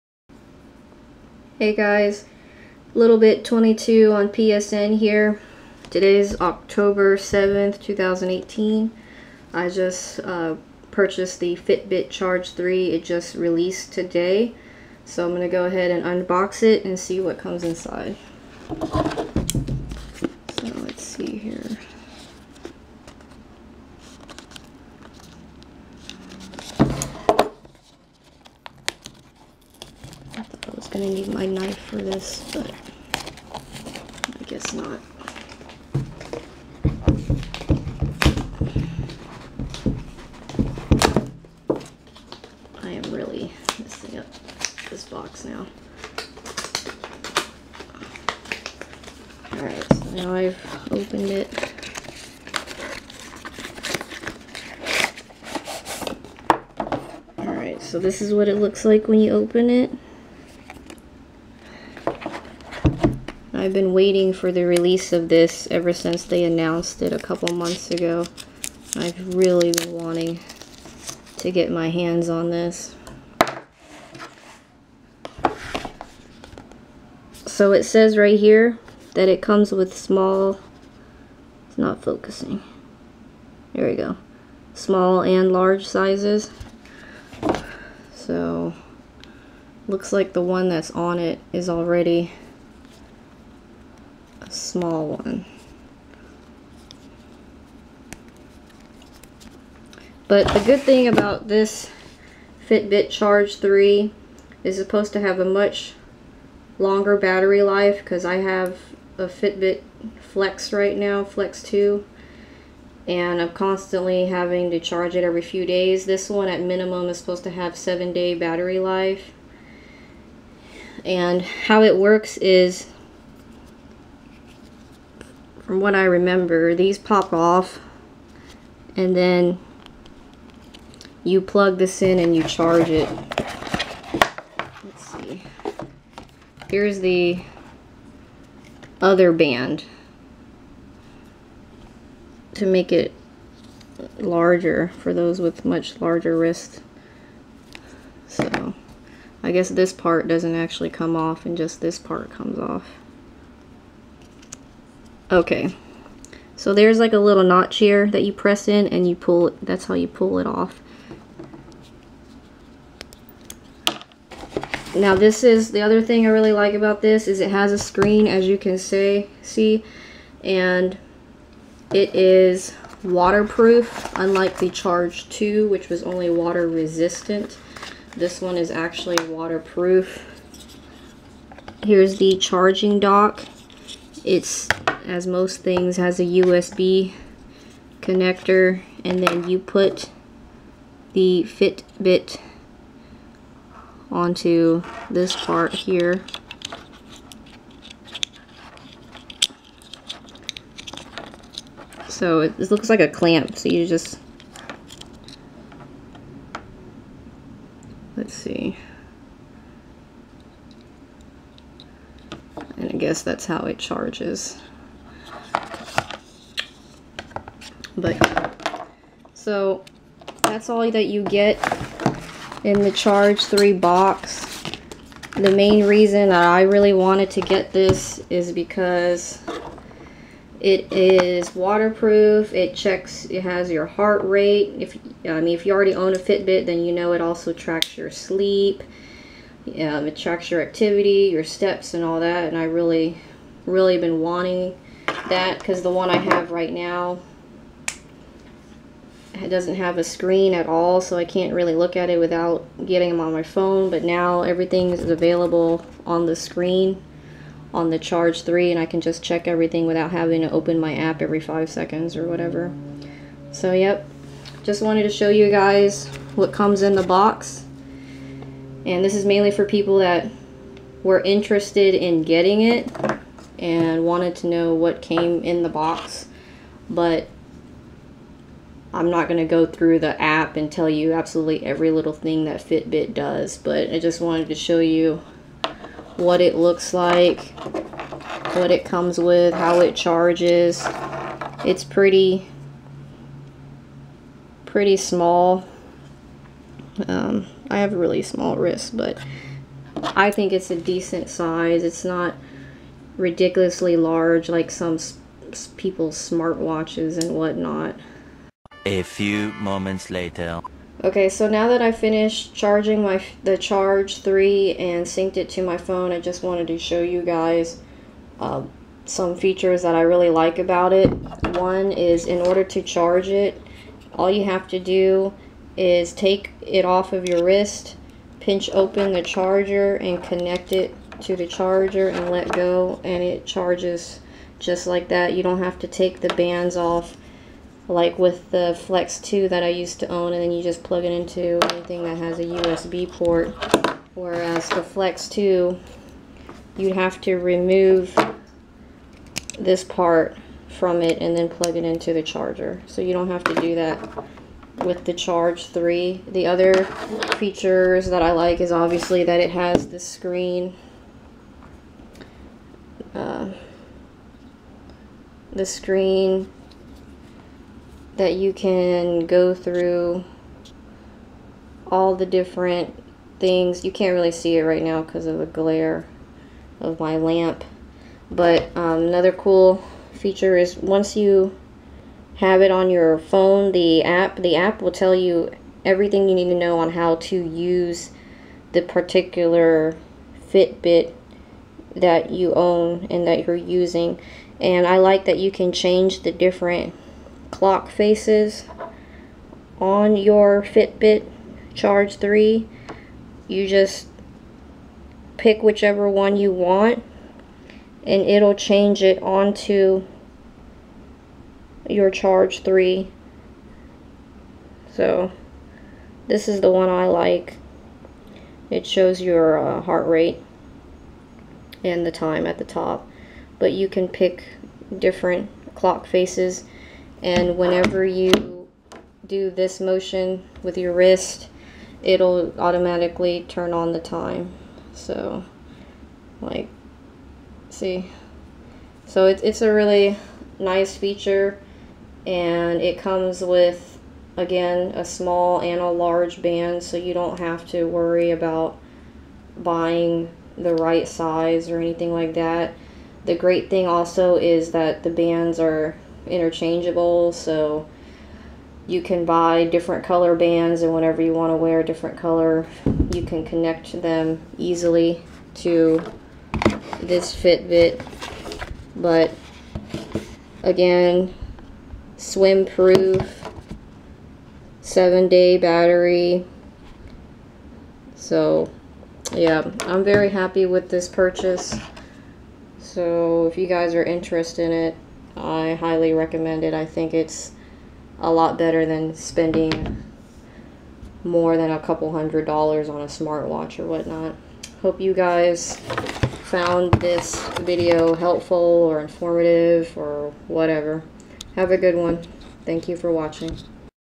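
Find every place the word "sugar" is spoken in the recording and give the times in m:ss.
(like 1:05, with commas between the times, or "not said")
not said.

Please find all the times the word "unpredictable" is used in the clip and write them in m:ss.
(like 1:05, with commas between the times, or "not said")
not said.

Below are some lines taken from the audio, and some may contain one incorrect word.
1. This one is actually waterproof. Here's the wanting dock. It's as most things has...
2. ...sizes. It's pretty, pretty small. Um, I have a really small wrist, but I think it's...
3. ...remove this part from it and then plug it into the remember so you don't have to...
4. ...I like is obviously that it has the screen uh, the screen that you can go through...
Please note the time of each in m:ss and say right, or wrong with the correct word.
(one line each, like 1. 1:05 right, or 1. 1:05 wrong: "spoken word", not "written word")
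1. 2:58 wrong: "charging", not "wanting"
2. 4:49 wrong: "charges", not "sizes"
3. 5:47 wrong: "charger", not "remember"
4. 5:58 right.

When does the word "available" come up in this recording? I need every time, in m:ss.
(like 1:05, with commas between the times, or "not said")
4:15.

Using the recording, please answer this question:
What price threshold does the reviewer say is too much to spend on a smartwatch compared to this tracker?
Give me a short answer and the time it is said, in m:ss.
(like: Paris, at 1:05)
a couple hundred dollars, at 8:11.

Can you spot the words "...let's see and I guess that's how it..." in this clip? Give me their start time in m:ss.
3:28.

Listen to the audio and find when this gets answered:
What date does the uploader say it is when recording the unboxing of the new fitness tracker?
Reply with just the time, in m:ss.
0:06.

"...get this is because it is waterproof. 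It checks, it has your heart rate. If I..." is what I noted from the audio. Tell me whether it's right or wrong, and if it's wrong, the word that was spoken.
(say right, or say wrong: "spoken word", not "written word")
right.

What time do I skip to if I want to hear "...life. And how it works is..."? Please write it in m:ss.
1:58.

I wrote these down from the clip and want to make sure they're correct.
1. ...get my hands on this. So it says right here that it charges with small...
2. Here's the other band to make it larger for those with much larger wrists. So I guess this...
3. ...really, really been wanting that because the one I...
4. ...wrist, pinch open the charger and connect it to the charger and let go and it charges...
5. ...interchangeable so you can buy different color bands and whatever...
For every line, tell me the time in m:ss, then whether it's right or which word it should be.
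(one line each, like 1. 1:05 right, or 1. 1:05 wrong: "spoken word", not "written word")
1. 1:11 wrong: "comes", not "charges"
2. 2:16 right
3. 4:02 right
4. 5:27 right
5. 7:36 wrong: "whenever", not "whatever".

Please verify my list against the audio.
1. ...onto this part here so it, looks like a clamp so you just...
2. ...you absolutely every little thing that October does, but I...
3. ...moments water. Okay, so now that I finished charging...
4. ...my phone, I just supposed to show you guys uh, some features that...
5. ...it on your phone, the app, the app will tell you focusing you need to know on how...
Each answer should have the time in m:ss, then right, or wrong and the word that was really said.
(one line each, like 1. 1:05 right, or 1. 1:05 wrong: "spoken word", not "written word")
1. 3:14 right
2. 4:40 wrong: "Fitbit", not "October"
3. 5:09 wrong: "later", not "water"
4. 5:15 wrong: "wanted", not "supposed"
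5. 6:22 wrong: "everything", not "focusing".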